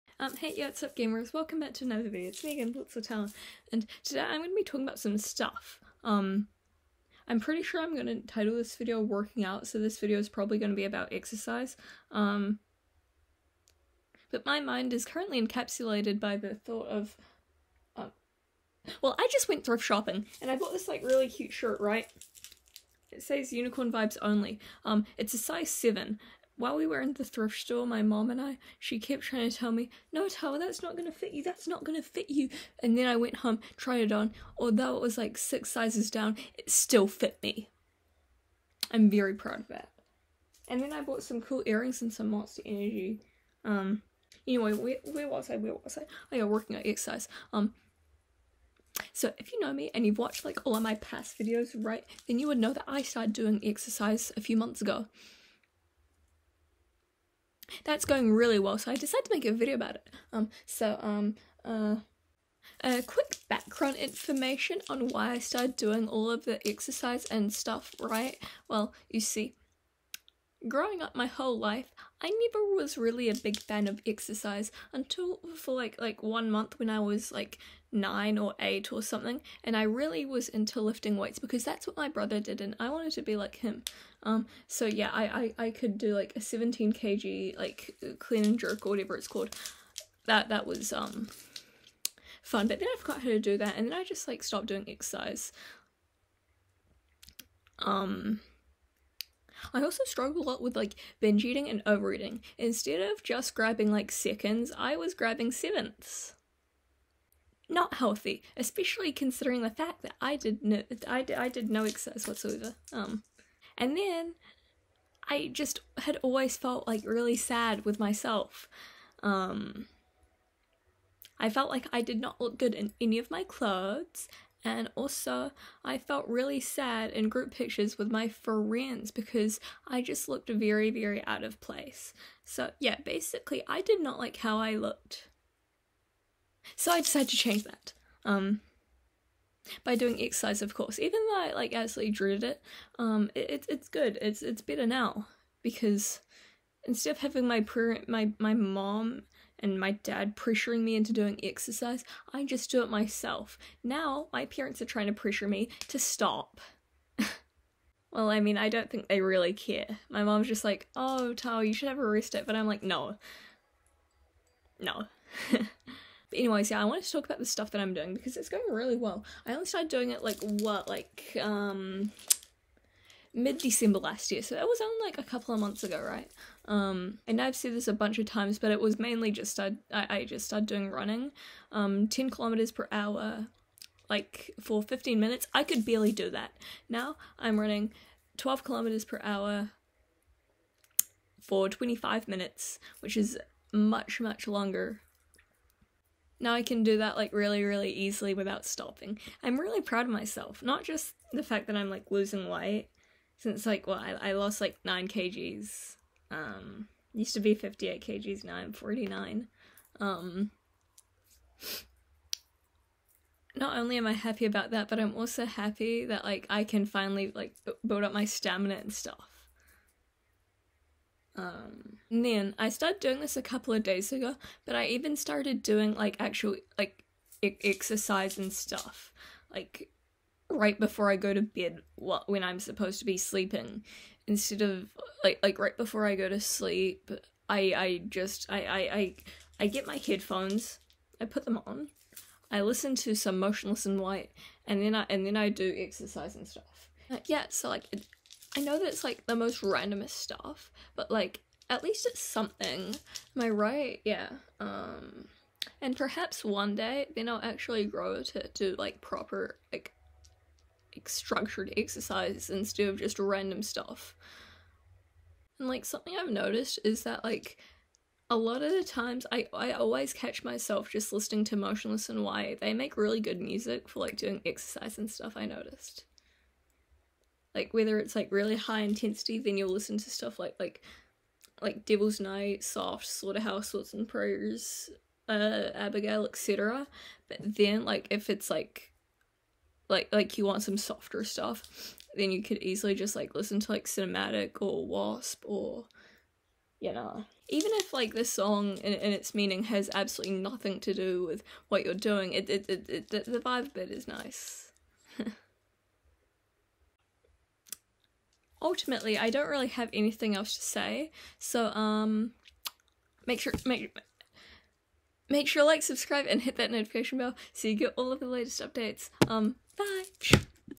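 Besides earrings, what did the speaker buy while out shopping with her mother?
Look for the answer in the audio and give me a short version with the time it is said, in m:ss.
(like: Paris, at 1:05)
Monster Energy, at 0:42.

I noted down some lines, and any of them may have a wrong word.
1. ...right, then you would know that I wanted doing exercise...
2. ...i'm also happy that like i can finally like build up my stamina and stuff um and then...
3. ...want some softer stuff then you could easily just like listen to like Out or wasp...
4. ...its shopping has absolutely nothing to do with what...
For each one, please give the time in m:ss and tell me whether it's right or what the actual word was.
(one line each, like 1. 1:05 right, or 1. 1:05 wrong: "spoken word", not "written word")
1. 0:51 wrong: "started", not "wanted"
2. 3:34 right
3. 4:50 wrong: "Sinematic", not "Out"
4. 4:58 wrong: "meaning", not "shopping".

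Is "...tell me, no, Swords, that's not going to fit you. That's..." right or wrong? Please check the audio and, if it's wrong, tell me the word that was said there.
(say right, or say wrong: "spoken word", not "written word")
wrong: "Tara", not "Swords".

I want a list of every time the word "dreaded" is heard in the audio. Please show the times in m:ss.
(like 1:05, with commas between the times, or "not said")
2:22.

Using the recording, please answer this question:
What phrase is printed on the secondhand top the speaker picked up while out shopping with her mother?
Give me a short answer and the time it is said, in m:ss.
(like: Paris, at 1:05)
Unicorn Vibes Only, at 0:23.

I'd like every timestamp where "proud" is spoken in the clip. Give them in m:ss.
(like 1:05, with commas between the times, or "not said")
0:39, 3:19.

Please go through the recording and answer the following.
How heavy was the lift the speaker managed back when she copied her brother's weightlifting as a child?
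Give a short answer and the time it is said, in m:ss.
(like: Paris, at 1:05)
17 kg, at 1:26.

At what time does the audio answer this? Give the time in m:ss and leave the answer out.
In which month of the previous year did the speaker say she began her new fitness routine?
2:53.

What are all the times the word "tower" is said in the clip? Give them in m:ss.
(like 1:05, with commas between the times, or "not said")
not said.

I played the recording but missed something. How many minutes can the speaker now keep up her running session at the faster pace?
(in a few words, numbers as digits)
25 minutes.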